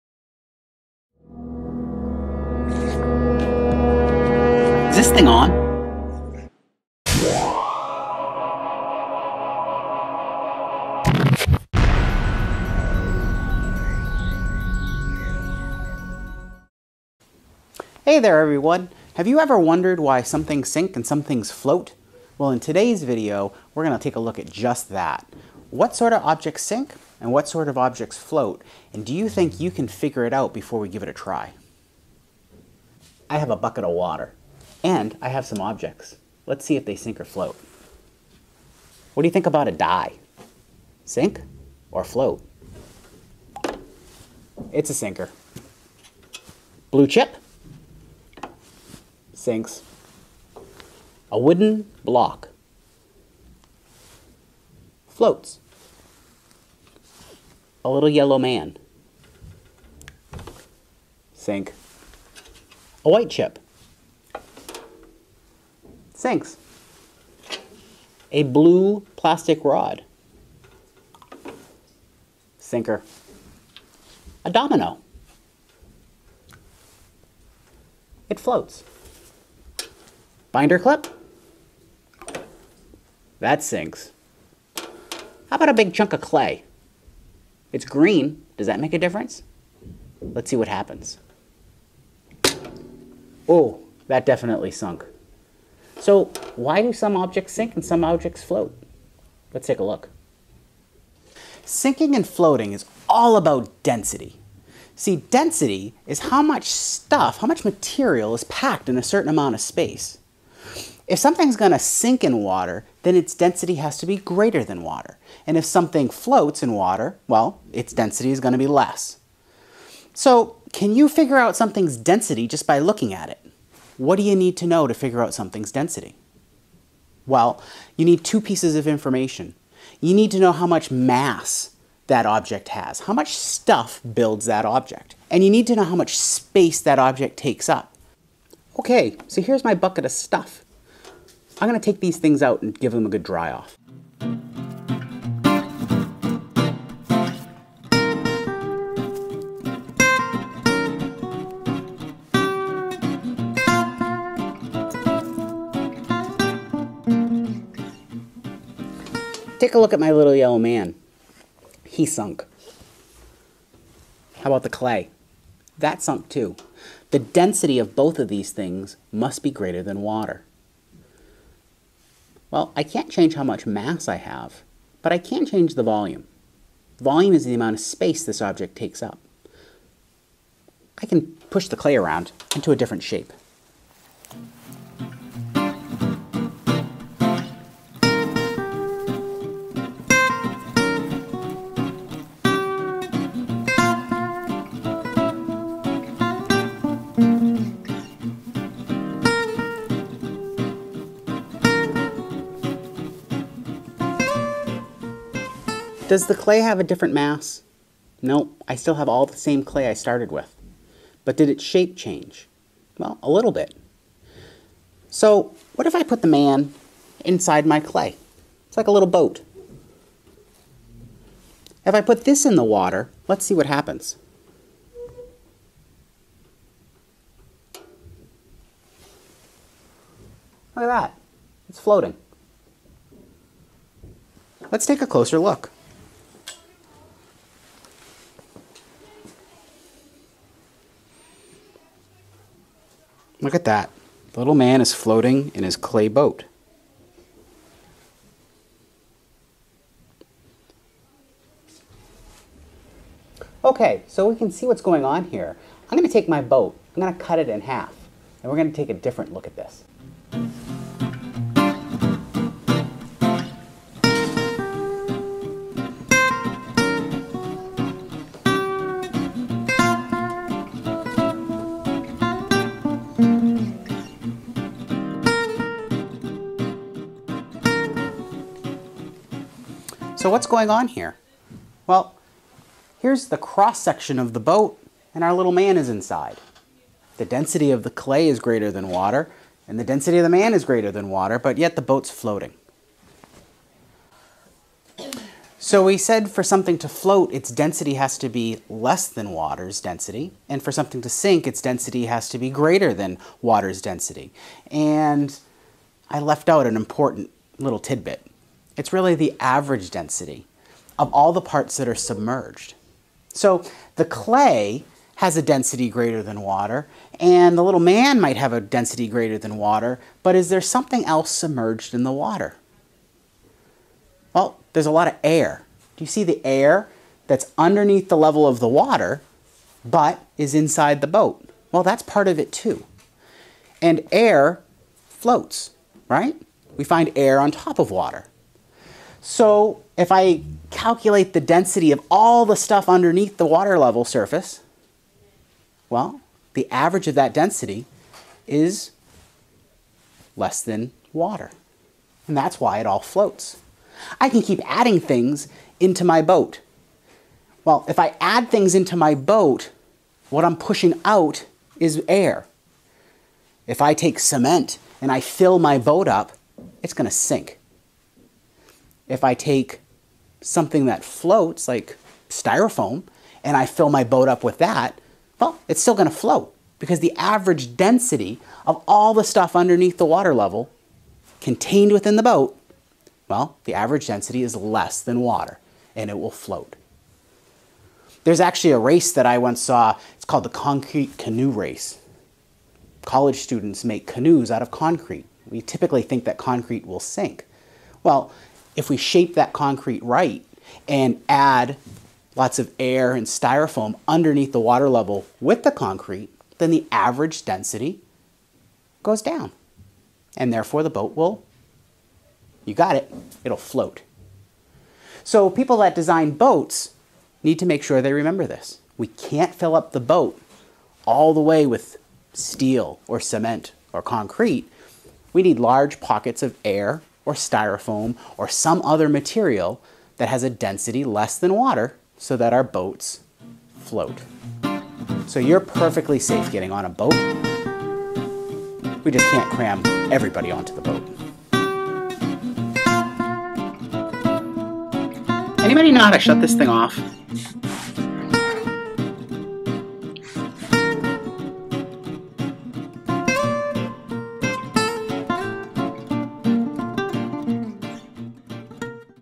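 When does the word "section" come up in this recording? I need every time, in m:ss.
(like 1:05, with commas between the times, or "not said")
4:43.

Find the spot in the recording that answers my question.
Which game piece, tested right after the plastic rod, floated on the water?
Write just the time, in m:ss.
1:14.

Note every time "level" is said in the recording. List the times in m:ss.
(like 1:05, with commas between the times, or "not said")
5:28, 5:43, 6:20, 6:44.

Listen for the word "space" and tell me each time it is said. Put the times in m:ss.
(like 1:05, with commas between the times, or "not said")
1:49, 2:16, 2:57.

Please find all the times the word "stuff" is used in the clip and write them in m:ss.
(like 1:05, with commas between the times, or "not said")
1:46, 2:13, 2:20, 5:42, 6:19.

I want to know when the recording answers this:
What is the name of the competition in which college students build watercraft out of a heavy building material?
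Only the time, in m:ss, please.
6:30.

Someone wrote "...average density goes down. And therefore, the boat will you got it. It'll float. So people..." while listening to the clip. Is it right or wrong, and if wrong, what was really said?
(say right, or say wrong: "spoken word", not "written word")
right.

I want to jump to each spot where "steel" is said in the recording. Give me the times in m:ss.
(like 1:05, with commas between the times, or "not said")
7:02.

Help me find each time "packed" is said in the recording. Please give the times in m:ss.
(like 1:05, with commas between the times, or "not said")
1:48.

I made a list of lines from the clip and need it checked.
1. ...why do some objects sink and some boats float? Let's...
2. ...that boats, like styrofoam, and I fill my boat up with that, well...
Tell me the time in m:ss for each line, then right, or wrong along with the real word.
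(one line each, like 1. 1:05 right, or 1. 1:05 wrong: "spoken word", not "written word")
1. 1:36 wrong: "objects", not "boats"
2. 6:10 wrong: "floats", not "boats".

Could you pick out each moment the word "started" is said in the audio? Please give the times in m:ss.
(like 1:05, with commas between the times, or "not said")
3:29.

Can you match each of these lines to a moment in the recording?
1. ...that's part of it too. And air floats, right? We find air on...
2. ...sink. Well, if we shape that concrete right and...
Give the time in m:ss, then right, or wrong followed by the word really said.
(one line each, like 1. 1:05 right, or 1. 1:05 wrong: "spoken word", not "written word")
1. 5:31 right
2. 6:36 right.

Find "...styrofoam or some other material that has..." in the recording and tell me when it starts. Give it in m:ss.
7:07.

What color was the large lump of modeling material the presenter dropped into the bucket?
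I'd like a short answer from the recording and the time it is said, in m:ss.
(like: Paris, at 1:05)
green, at 1:27.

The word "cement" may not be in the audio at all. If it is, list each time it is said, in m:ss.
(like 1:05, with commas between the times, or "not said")
6:04, 7:03.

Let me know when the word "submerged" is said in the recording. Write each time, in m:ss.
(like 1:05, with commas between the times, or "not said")
5:11, 5:21.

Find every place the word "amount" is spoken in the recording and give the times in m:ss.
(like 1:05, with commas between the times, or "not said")
1:49, 2:57.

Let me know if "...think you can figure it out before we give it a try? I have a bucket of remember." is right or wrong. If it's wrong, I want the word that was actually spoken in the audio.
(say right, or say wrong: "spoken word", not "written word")
wrong: "water", not "remember".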